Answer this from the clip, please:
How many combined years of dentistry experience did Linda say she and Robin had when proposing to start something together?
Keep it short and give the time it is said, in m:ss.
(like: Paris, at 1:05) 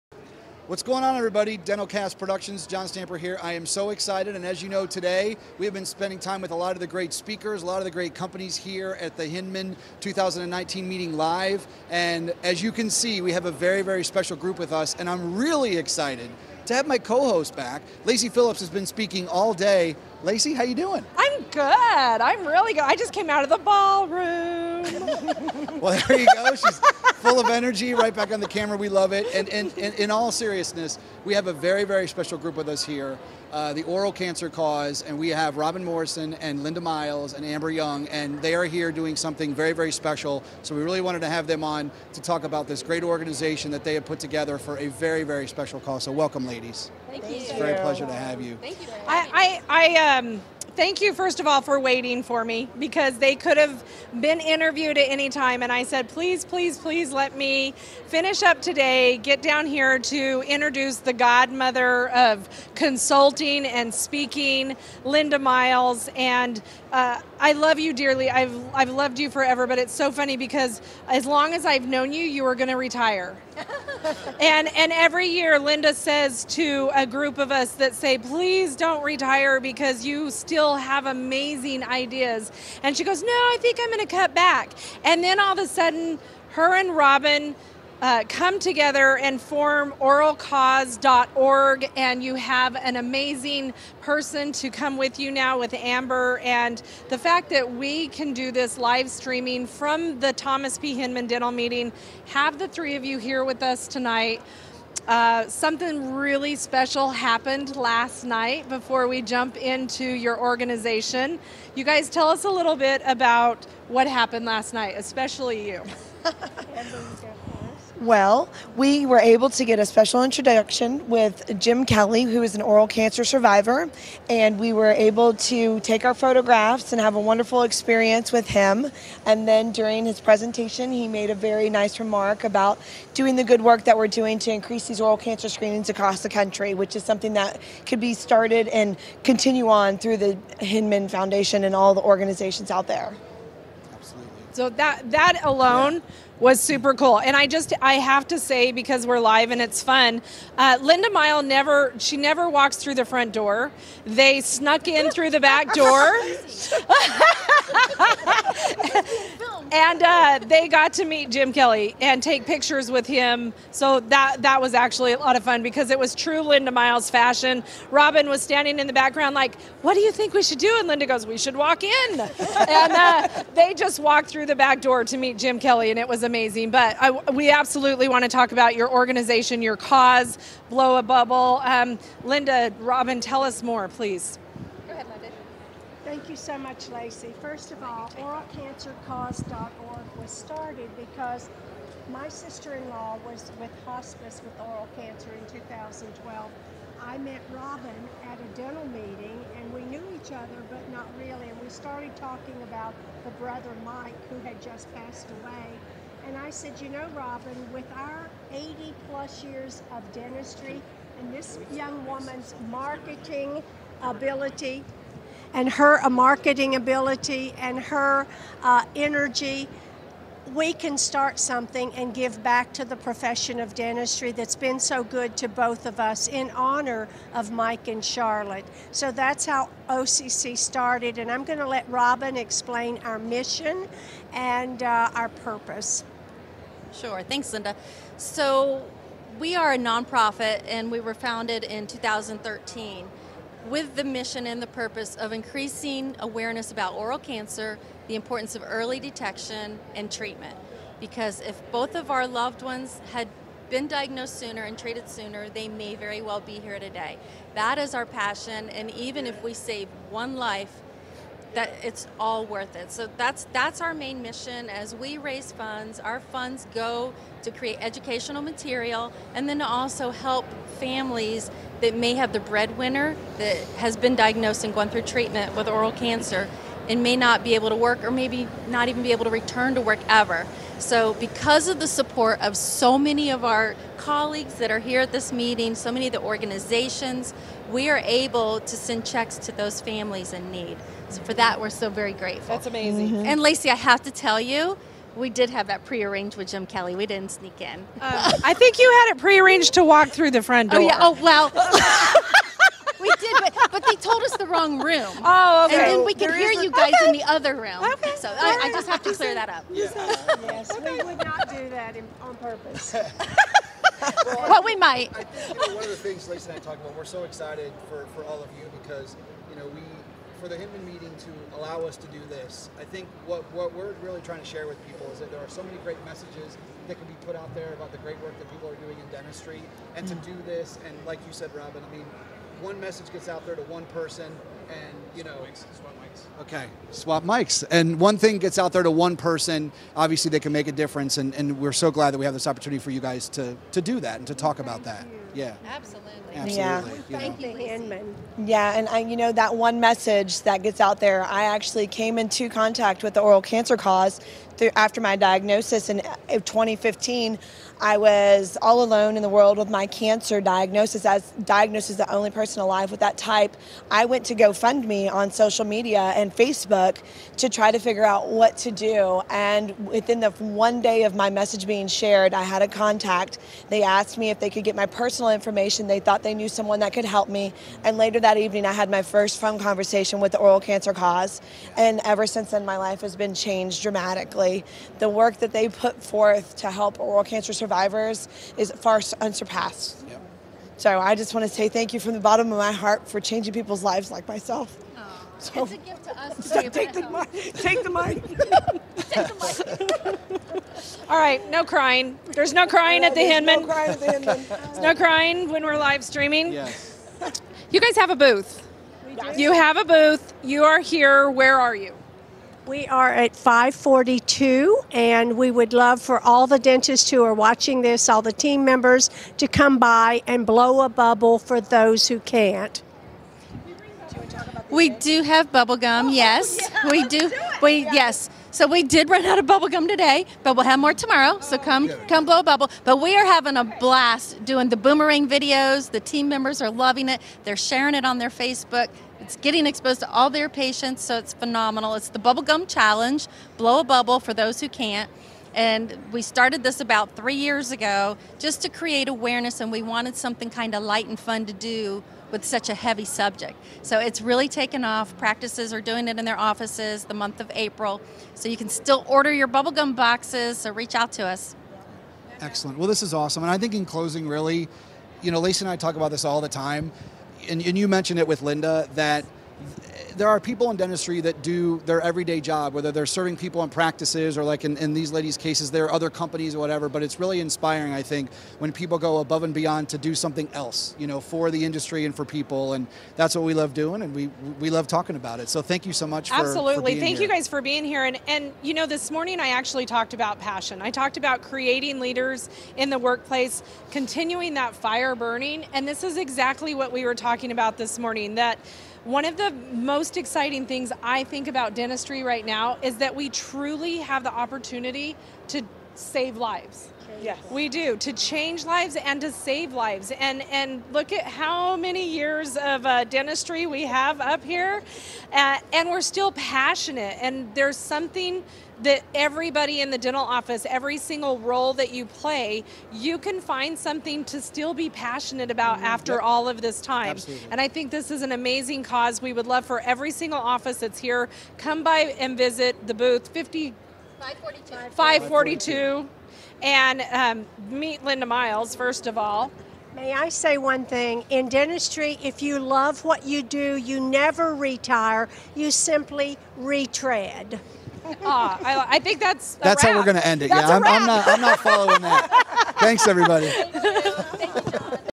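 80 plus, at 3:28.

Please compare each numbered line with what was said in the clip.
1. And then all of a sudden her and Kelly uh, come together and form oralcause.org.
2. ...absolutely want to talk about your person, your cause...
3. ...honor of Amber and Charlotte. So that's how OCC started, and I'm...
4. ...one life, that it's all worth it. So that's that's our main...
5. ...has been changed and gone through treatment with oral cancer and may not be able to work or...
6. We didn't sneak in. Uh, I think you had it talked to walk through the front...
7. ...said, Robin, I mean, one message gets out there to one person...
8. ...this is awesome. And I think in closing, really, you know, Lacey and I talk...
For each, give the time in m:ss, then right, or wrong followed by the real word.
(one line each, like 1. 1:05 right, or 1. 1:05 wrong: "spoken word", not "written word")
1. 1:25 wrong: "Robin", not "Kelly"
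2. 2:57 wrong: "organization", not "person"
3. 3:46 wrong: "Mike", not "Amber"
4. 4:20 right
5. 4:33 wrong: "diagnosed", not "changed"
6. 4:56 wrong: "prearranged", not "talked"
7. 5:31 right
8. 7:42 right.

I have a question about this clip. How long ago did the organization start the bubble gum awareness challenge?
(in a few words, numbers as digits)
about three years.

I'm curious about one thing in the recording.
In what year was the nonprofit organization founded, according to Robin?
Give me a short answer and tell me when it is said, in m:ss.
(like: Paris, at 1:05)
2013, at 4:01.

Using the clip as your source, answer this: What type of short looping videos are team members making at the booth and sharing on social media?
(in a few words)
boomerang videos.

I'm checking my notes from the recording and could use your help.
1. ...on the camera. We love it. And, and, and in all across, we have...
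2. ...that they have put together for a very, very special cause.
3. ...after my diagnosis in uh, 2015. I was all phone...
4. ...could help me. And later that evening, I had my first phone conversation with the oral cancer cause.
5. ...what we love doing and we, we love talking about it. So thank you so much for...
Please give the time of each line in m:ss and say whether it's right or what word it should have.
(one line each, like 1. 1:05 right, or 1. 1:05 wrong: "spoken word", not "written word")
1. 0:28 wrong: "seriousness", not "across"
2. 0:43 right
3. 5:54 wrong: "alone", not "phone"
4. 6:16 right
5. 8:03 right.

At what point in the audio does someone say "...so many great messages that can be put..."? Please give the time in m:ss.
5:25.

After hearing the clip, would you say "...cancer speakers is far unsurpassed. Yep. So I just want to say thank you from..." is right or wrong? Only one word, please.
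wrong.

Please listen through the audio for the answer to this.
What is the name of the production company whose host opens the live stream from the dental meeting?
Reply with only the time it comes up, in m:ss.
0:01.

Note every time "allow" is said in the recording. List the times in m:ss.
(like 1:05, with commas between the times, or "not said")
5:21.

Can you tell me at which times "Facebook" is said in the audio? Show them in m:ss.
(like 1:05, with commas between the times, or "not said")
6:06, 7:18.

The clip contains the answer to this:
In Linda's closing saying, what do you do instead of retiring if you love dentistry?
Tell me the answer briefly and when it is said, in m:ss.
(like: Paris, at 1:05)
retread, at 9:06.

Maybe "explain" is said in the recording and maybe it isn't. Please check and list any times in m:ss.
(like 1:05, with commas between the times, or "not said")
3:52.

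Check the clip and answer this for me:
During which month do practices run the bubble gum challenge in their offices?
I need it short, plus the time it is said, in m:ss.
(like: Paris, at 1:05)
April, at 7:37.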